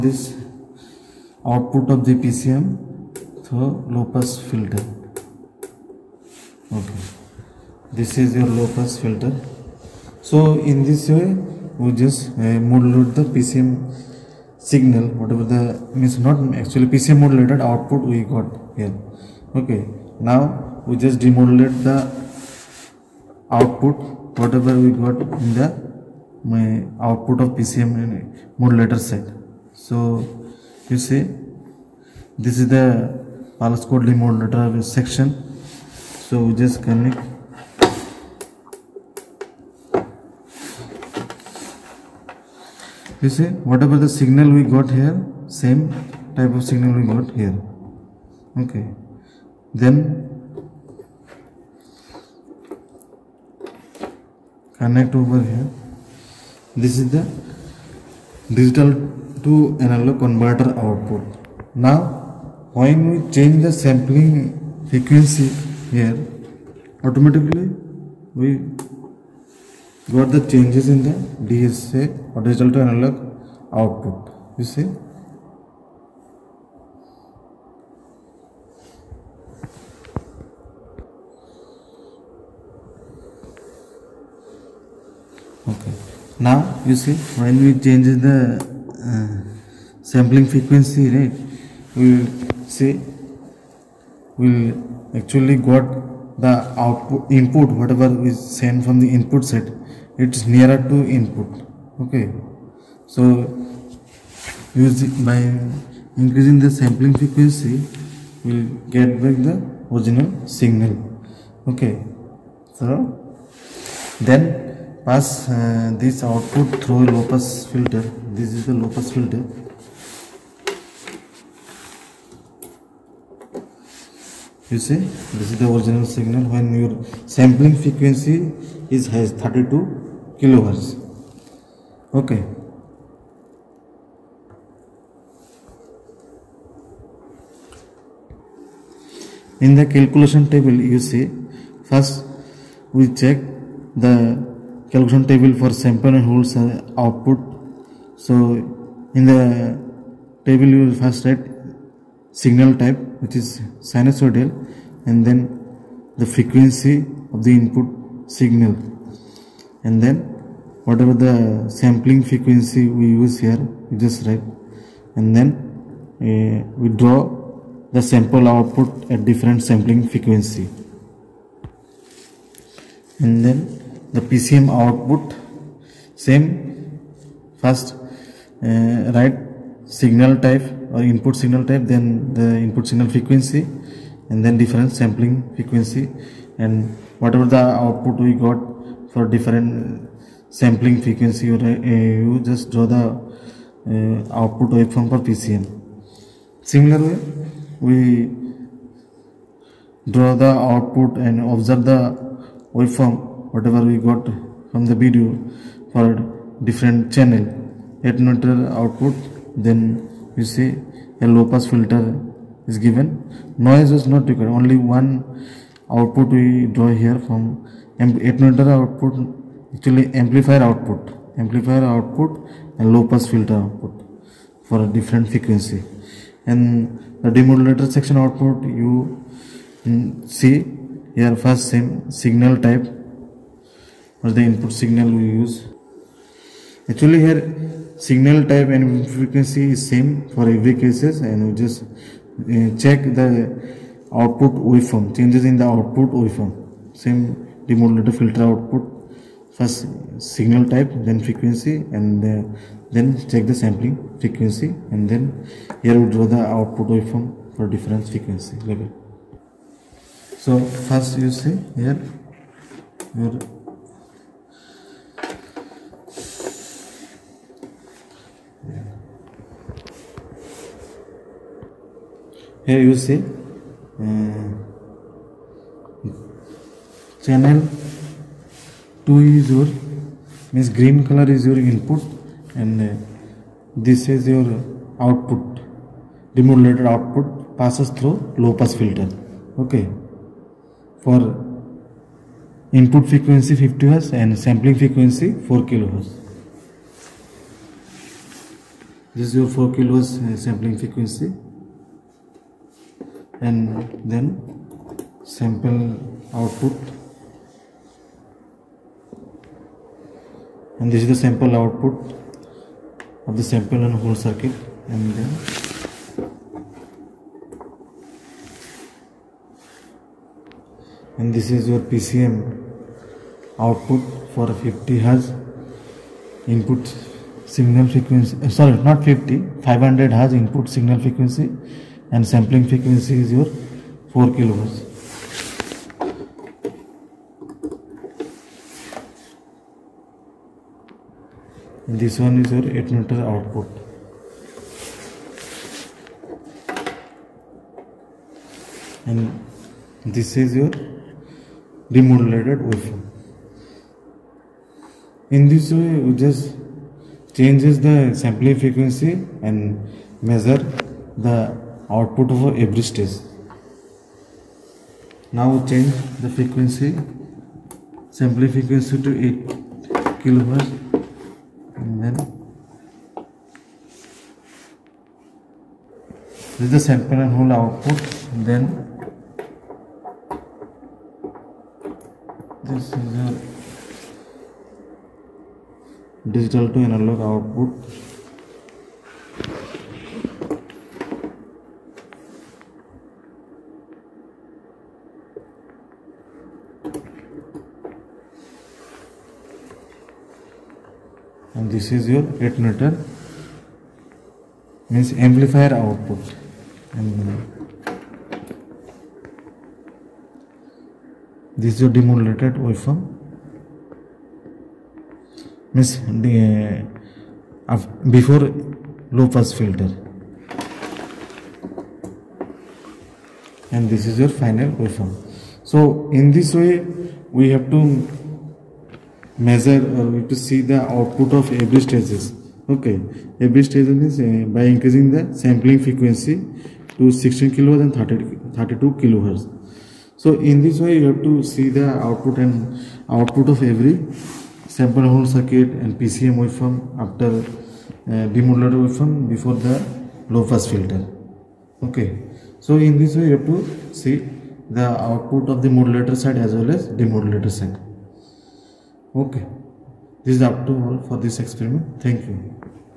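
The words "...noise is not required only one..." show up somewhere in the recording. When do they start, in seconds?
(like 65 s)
213 s.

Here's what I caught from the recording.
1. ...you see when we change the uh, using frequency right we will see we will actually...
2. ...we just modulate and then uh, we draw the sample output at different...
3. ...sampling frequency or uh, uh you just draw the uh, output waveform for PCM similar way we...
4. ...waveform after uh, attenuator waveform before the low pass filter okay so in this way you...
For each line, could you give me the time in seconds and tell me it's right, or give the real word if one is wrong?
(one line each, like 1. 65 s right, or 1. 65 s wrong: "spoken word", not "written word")
1. 86 s wrong: "sampling", not "using"
2. 163 s wrong: "write", not "modulate"
3. 190 s right
4. 446 s wrong: "demodulator", not "attenuator".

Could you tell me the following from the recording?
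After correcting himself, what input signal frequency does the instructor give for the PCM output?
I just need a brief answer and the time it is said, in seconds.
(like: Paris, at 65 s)
500 Hz, at 329 s.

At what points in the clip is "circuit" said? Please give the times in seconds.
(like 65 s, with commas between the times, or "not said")
314 s, 445 s.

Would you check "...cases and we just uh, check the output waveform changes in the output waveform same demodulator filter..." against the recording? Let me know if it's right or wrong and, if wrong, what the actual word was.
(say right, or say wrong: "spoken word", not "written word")
right.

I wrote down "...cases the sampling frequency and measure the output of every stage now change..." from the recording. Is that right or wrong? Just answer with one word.
wrong.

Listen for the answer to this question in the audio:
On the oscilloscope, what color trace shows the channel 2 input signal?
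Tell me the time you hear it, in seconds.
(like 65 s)
280 s.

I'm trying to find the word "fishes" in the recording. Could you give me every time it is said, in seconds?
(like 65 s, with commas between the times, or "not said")
not said.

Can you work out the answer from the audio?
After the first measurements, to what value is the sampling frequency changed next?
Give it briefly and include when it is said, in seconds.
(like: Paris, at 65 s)
8 kHz, at 369 s.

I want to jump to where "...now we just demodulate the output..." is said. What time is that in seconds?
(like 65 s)
20 s.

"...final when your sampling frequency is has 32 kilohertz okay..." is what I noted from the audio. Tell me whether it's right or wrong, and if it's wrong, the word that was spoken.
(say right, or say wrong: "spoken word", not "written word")
wrong: "signal", not "final".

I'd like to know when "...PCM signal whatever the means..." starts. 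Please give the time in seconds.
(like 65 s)
13 s.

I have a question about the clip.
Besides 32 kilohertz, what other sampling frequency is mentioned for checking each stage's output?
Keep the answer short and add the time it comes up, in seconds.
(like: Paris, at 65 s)
16 kHz, at 437 s.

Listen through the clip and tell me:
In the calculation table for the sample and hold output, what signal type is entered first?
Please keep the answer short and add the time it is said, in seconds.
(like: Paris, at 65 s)
sinusoidal, at 153 s.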